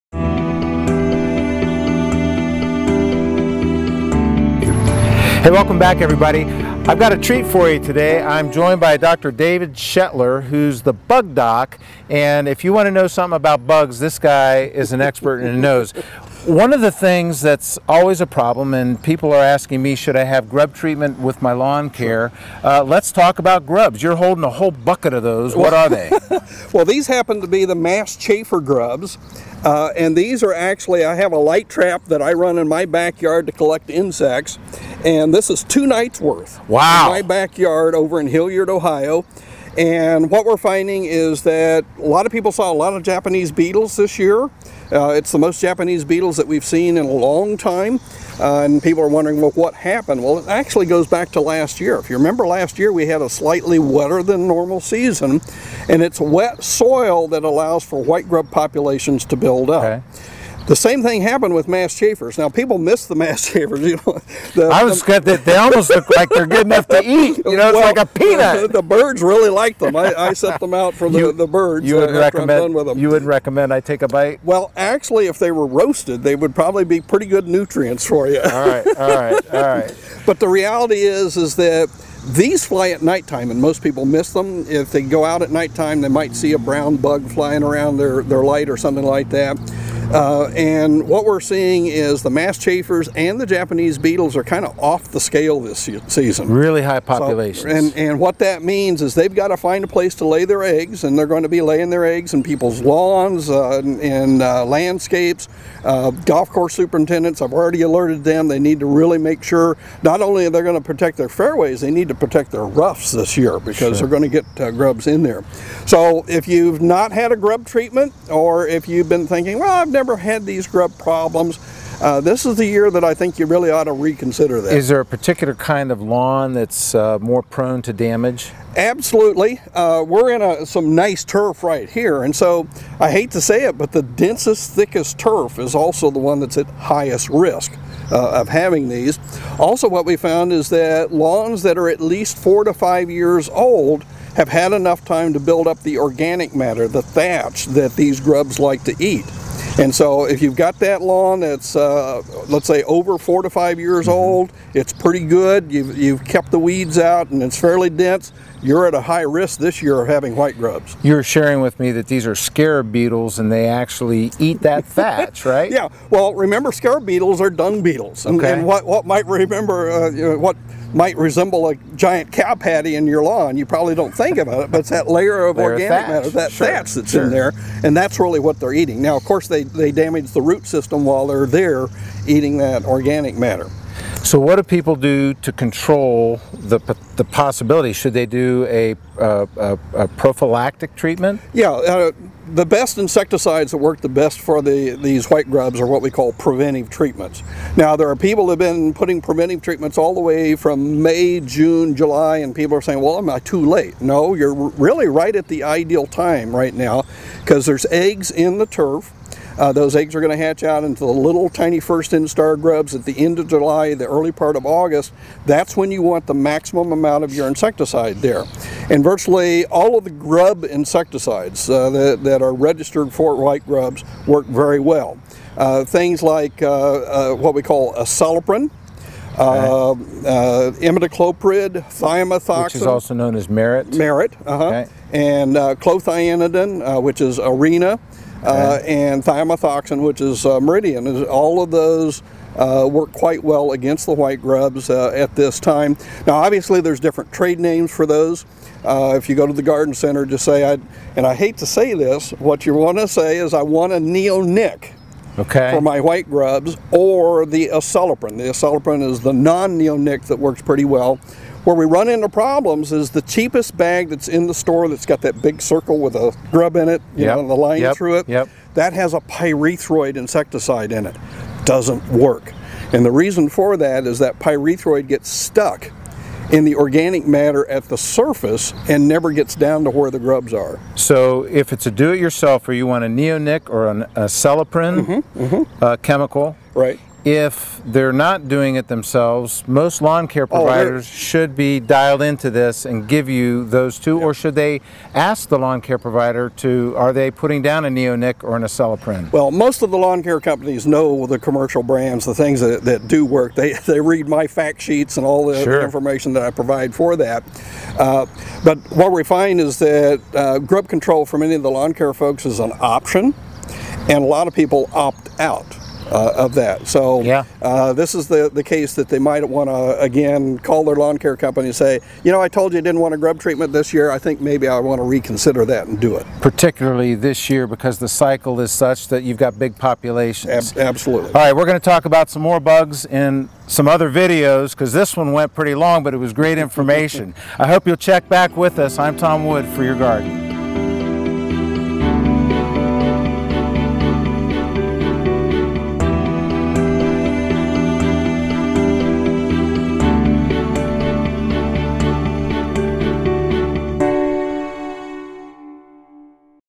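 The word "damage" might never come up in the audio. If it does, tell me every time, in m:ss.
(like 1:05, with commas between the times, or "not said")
2:07, 2:59.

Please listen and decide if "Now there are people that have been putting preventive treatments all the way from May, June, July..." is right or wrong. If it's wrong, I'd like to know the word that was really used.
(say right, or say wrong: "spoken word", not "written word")
right.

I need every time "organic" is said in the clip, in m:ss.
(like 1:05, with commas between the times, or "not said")
2:25, 2:55, 3:02, 4:36.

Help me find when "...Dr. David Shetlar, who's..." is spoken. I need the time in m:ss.
0:08.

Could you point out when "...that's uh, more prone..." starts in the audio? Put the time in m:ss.
2:06.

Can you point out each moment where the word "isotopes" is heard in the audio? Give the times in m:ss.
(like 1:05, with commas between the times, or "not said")
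not said.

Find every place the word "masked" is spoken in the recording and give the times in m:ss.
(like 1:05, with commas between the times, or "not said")
0:27, 1:01, 1:32.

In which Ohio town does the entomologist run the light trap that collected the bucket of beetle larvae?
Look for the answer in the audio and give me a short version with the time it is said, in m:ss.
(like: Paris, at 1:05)
Hilliard, at 0:38.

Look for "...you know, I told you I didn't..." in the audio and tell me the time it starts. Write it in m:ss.
5:22.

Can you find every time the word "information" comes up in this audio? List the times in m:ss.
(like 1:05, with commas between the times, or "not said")
5:05, 5:36.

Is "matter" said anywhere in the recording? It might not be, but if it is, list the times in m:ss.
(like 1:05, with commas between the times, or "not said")
2:26, 2:56, 3:03, 4:37.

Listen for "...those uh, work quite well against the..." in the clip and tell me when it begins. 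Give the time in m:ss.
4:01.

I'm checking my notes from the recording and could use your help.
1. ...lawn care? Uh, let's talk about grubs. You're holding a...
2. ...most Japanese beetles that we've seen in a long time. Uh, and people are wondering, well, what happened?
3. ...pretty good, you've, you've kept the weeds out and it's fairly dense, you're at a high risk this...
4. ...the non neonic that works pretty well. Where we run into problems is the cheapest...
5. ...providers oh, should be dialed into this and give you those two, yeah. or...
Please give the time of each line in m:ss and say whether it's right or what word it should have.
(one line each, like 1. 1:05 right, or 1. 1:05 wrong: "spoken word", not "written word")
1. 0:21 right
2. 0:45 right
3. 2:34 right
4. 4:19 right
5. 4:50 right.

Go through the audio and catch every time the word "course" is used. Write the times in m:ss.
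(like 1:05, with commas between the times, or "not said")
1:46, 2:59.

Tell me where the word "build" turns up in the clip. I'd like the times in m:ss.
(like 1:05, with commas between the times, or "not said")
0:59, 2:25.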